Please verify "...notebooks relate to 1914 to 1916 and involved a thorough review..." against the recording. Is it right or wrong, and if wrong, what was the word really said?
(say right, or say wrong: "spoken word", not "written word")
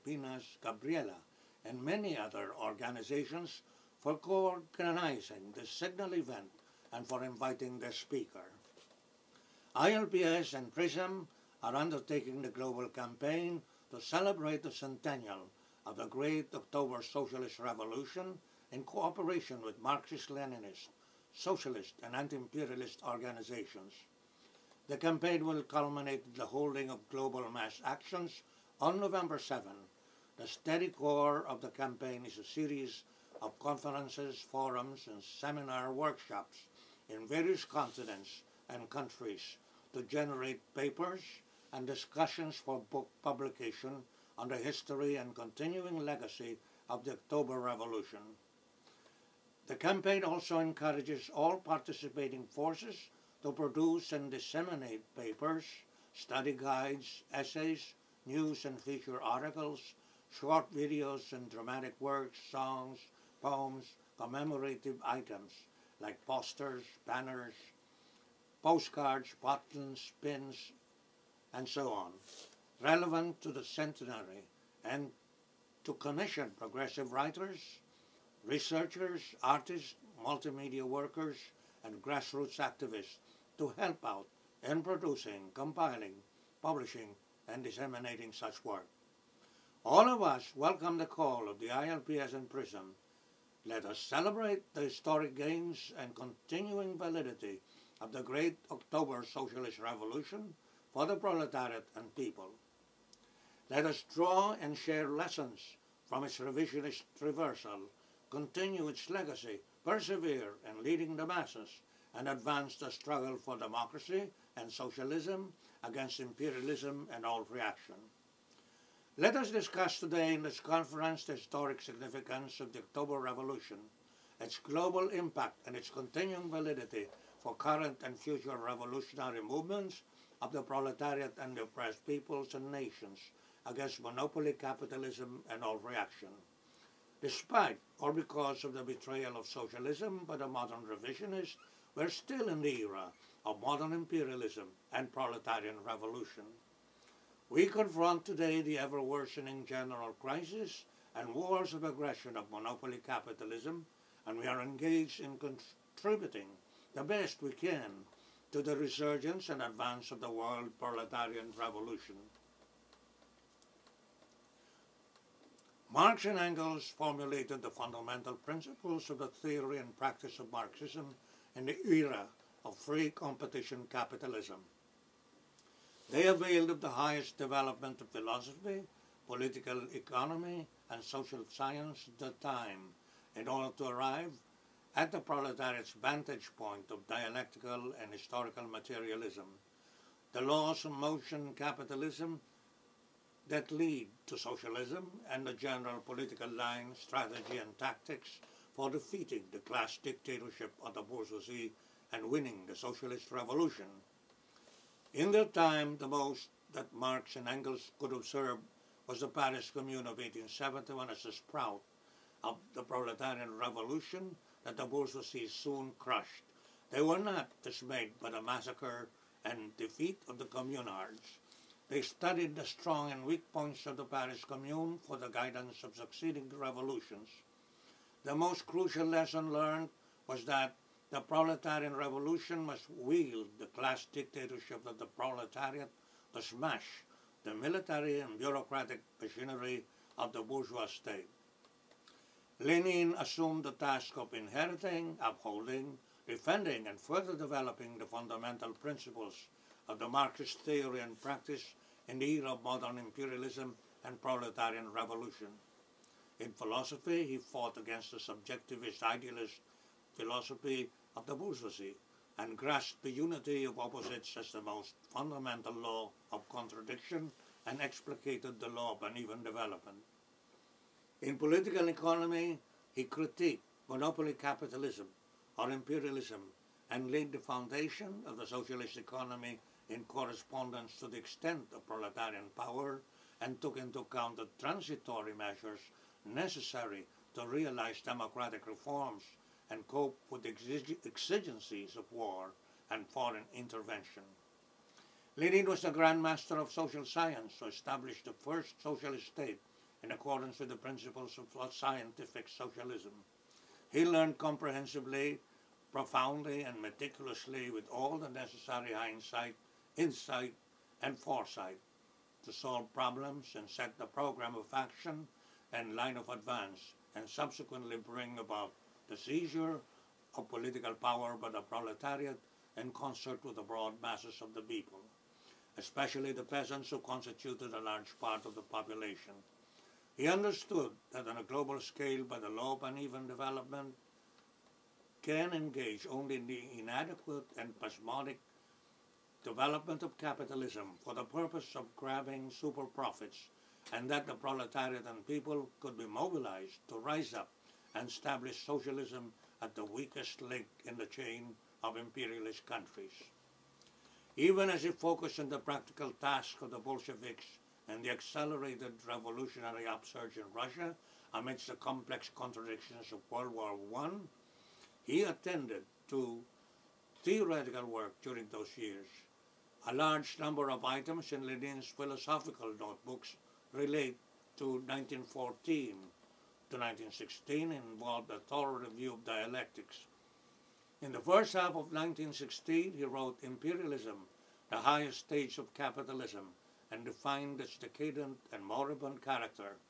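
right.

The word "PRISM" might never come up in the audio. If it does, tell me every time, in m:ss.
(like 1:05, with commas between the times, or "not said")
0:10, 1:32.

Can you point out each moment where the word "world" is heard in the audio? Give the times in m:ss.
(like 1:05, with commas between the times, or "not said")
2:40, 6:03.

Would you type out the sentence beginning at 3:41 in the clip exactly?
They studied the strong and weak points of the Paris Commune for the guidance of succeeding revolutions.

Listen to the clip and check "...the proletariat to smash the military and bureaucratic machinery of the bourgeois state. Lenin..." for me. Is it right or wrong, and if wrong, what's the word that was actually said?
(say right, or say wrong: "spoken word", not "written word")
right.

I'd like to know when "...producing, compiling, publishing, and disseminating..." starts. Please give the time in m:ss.
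1:24.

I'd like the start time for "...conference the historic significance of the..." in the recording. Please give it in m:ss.
2:00.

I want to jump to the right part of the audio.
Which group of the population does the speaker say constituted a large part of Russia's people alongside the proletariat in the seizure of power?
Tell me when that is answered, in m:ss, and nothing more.
5:26.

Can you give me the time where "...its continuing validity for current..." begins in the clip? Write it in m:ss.
2:05.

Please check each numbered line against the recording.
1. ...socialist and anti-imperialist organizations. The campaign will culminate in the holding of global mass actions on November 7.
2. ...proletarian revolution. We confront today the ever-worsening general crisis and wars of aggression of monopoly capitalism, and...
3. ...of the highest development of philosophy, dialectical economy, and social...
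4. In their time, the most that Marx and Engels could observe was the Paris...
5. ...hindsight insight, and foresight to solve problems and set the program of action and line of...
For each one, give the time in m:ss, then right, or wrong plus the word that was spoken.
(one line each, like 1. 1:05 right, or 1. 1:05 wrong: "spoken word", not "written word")
1. 0:21 right
2. 2:25 right
3. 2:56 wrong: "political", not "dialectical"
4. 3:25 right
5. 5:08 right.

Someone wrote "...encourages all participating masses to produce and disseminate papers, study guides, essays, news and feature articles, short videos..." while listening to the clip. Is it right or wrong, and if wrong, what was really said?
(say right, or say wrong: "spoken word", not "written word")
wrong: "forces", not "masses".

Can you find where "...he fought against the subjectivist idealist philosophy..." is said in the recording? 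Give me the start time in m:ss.
4:17.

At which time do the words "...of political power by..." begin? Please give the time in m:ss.
5:20.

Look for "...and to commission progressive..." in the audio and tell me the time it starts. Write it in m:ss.
1:14.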